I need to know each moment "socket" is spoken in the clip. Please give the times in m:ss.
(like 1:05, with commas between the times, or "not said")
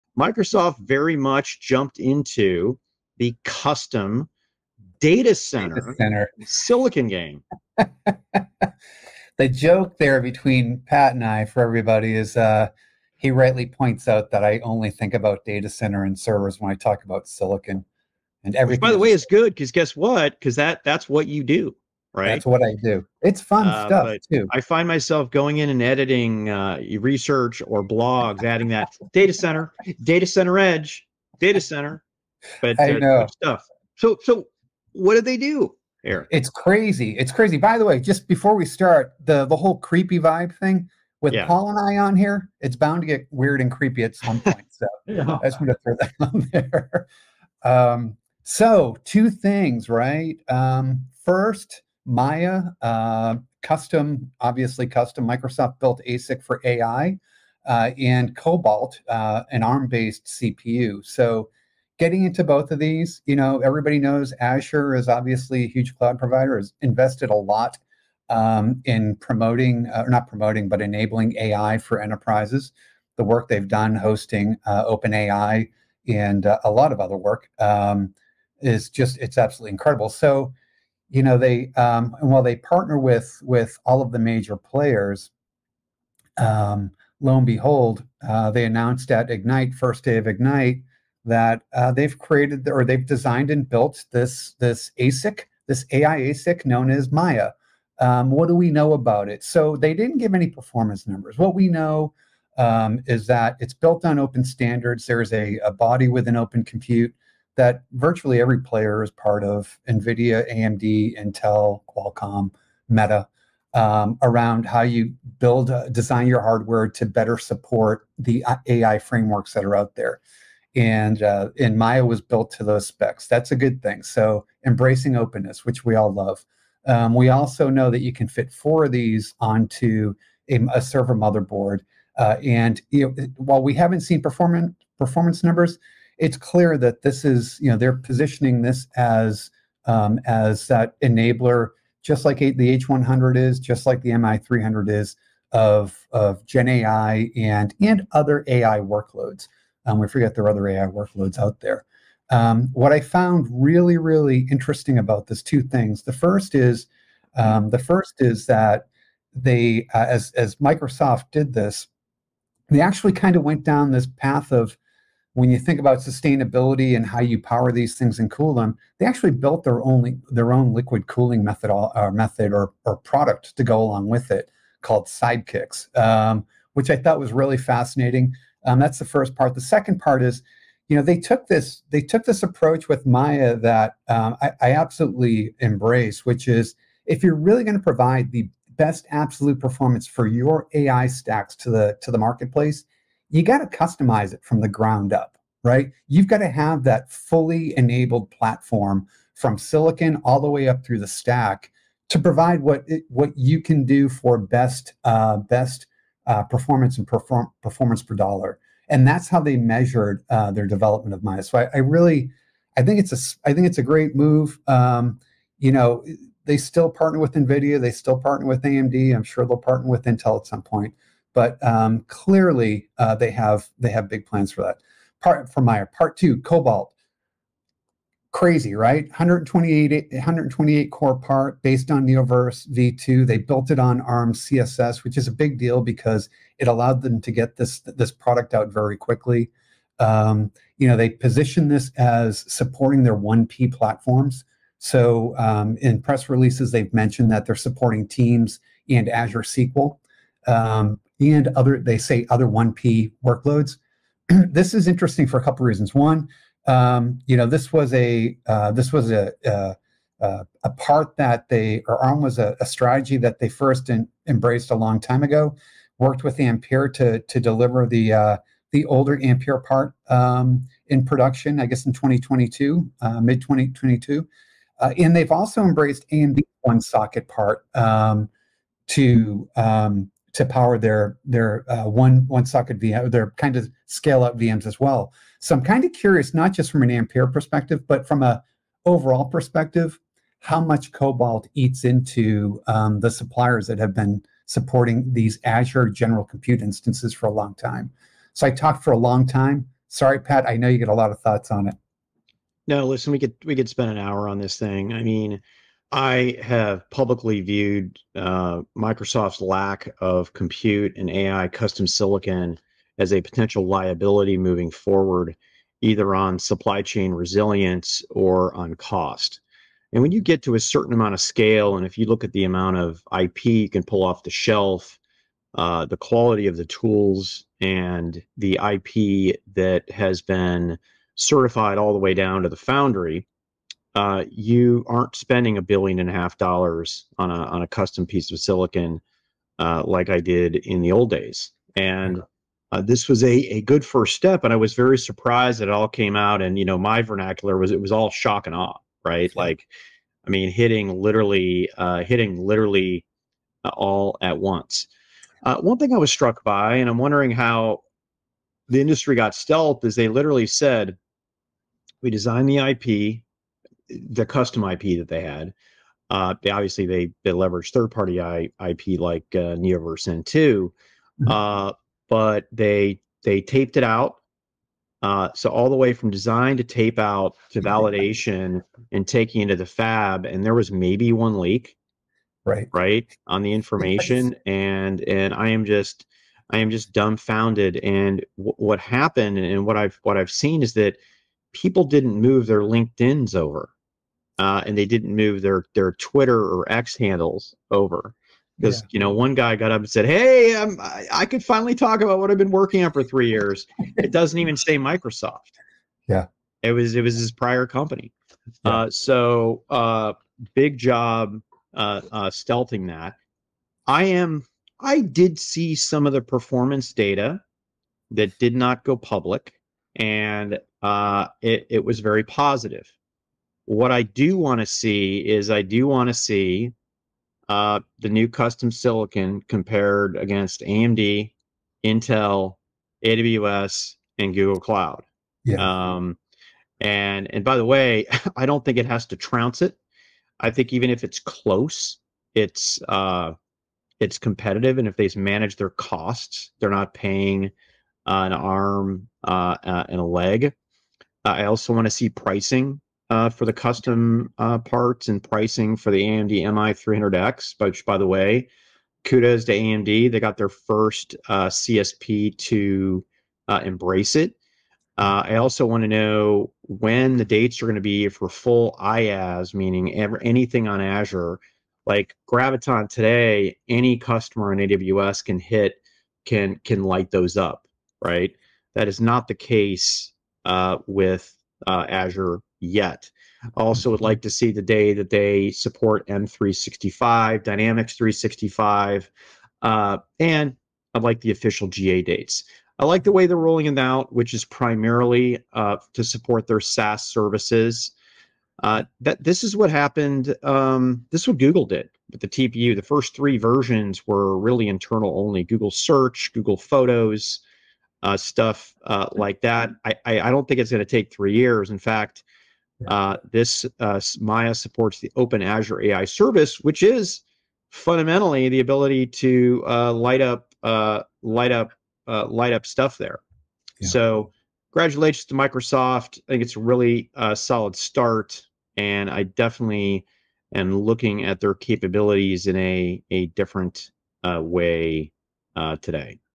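4:36, 4:42.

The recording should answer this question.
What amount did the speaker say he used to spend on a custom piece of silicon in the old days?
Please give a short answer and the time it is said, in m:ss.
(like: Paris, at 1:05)
a billion and a half dollars, at 5:35.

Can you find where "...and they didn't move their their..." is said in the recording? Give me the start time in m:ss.
6:34.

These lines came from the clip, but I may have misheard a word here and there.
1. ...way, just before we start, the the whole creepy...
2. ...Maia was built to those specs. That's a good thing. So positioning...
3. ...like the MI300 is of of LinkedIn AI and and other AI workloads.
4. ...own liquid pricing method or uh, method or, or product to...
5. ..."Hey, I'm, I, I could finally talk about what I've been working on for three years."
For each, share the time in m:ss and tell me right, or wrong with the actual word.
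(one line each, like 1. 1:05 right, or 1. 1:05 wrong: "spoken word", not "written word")
1. 0:37 right
2. 2:01 wrong: "embracing", not "positioning"
3. 2:23 wrong: "Gen", not "LinkedIn"
4. 2:50 wrong: "cooling", not "pricing"
5. 6:40 right.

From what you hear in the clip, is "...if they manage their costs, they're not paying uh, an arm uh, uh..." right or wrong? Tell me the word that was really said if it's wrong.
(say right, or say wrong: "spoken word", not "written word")
right.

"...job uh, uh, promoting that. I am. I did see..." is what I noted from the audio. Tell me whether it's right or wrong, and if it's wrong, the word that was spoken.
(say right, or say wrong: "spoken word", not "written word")
wrong: "stealthing", not "promoting".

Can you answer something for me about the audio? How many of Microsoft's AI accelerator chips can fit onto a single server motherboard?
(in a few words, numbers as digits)
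4.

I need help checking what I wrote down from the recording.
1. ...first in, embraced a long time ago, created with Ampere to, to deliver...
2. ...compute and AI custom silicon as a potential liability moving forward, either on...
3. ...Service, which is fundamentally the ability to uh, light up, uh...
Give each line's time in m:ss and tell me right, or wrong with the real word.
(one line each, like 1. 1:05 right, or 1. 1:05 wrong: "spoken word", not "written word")
1. 4:23 wrong: "worked", not "created"
2. 5:10 right
3. 8:36 right.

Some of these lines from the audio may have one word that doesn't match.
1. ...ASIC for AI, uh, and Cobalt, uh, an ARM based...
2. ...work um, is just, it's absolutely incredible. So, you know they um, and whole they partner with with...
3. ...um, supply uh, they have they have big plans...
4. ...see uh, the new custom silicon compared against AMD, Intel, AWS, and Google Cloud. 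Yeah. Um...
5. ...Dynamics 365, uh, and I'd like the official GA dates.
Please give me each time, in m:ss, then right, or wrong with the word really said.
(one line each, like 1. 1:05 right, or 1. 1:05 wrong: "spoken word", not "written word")
1. 0:56 right
2. 1:17 wrong: "while", not "whole"
3. 3:41 wrong: "clearly", not "supply"
4. 7:06 right
5. 8:07 right.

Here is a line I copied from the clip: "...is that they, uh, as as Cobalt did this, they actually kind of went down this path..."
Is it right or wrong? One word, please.
wrong.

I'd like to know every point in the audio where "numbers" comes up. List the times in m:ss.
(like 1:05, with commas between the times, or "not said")
1:41, 2:15.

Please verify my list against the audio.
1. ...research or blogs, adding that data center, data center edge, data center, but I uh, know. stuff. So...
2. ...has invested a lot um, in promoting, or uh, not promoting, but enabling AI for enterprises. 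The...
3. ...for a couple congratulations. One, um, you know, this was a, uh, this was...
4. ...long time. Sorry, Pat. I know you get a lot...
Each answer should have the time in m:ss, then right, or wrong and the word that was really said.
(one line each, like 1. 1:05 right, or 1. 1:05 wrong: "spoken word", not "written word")
1. 0:26 right
2. 1:06 right
3. 4:15 wrong: "reasons", not "congratulations"
4. 4:58 right.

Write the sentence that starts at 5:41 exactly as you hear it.
And uh, this was a a good first step, and I was very surprised that it all came out.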